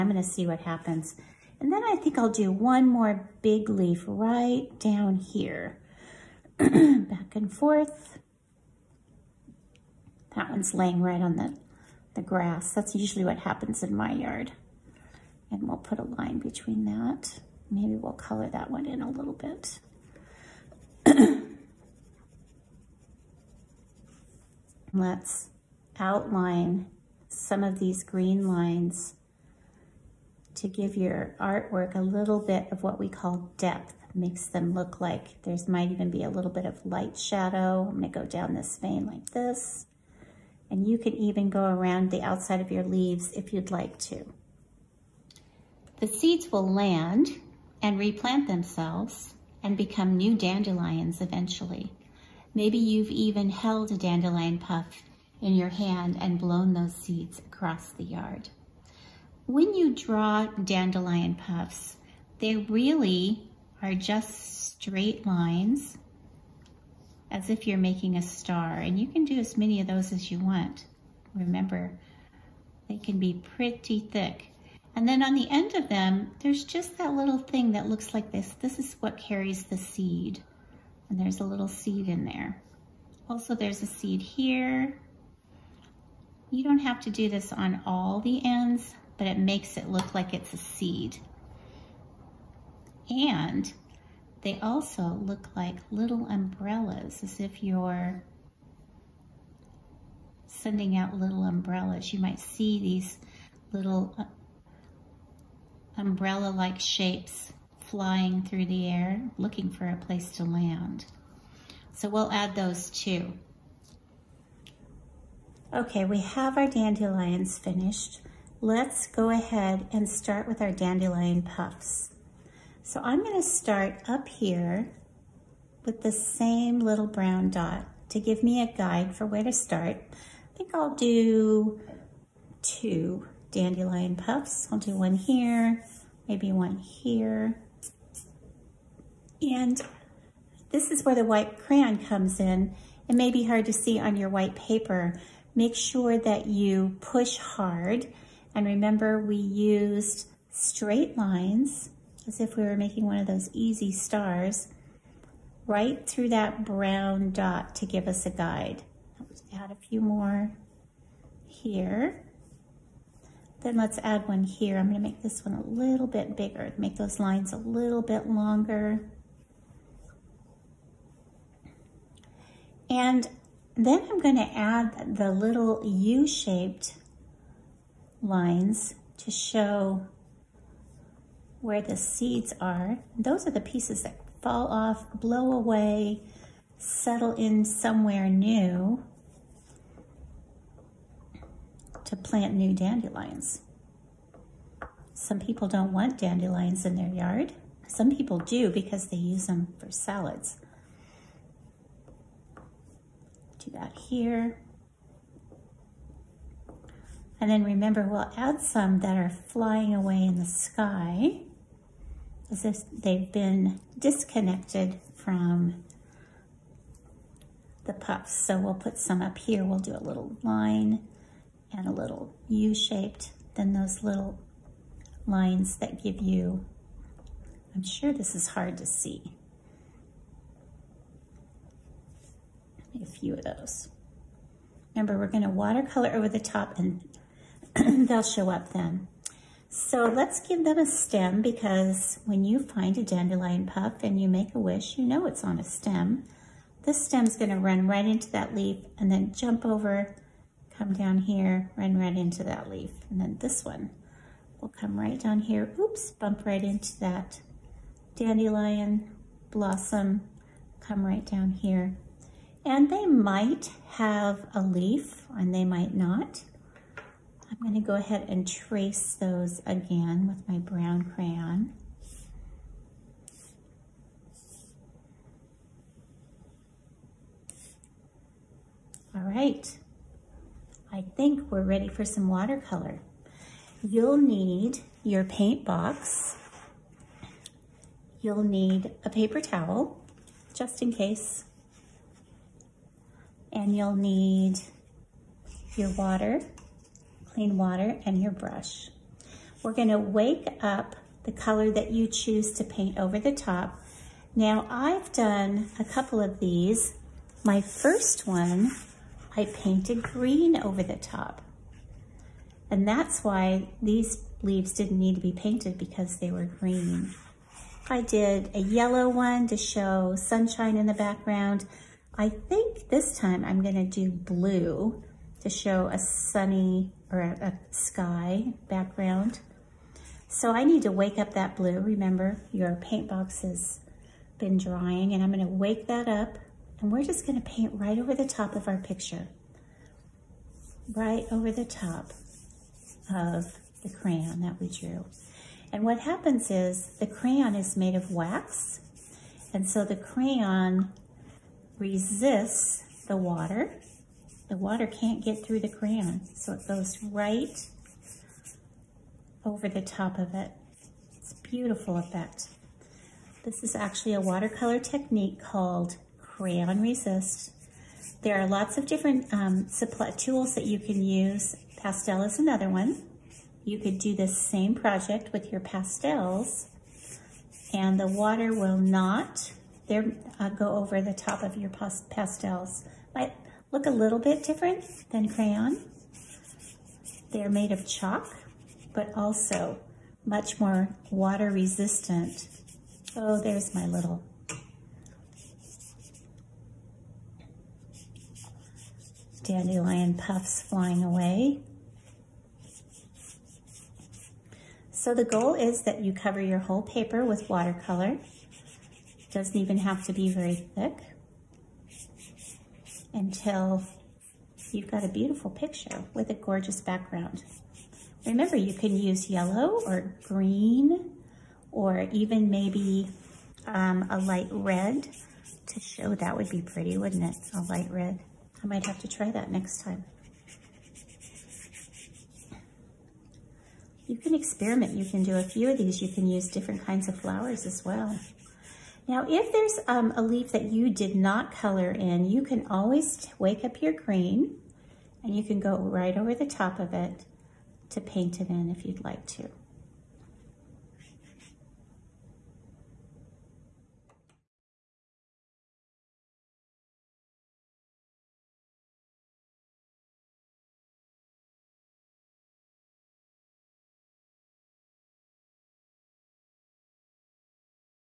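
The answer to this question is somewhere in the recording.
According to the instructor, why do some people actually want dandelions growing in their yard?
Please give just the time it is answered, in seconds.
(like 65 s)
199 s.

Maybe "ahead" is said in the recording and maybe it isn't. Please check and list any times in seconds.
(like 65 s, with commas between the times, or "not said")
119 s, 267 s.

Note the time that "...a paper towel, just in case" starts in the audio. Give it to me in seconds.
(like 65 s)
289 s.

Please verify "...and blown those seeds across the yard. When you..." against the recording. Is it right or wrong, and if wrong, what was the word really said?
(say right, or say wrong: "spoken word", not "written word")
right.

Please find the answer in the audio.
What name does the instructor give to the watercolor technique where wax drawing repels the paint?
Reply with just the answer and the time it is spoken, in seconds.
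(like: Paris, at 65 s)
Crayon Resist, at 366 s.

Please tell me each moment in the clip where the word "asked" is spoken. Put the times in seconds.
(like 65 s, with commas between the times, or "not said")
not said.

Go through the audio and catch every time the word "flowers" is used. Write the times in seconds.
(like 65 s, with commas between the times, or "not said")
437 s.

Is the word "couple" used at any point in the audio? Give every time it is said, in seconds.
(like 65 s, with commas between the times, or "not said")
305 s.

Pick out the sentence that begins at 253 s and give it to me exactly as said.
And then this one will come right down here, oops, bump right into that dandelion blossom, come right down here.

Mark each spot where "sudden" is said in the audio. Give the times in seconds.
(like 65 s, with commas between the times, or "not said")
not said.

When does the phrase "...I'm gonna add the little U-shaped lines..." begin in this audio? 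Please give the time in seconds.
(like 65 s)
174 s.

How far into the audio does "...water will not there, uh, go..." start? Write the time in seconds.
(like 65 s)
378 s.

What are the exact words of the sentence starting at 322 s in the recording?
I think this time I'm gonna do blue to show a sunny or a, a sky background.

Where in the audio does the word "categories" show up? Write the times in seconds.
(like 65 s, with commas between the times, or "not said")
not said.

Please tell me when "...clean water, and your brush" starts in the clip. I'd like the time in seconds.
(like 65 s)
297 s.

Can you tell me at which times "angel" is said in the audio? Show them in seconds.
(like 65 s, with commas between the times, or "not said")
not said.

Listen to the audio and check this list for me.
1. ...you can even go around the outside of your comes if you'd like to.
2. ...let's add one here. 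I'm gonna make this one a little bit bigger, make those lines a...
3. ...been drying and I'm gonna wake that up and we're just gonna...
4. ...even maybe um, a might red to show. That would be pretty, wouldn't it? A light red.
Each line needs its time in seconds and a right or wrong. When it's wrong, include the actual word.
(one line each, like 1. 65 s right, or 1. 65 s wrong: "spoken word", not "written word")
1. 40 s wrong: "leaves", not "comes"
2. 163 s right
3. 334 s right
4. 422 s wrong: "light", not "might".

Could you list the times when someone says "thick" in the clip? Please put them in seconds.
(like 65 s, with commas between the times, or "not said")
73 s, 410 s.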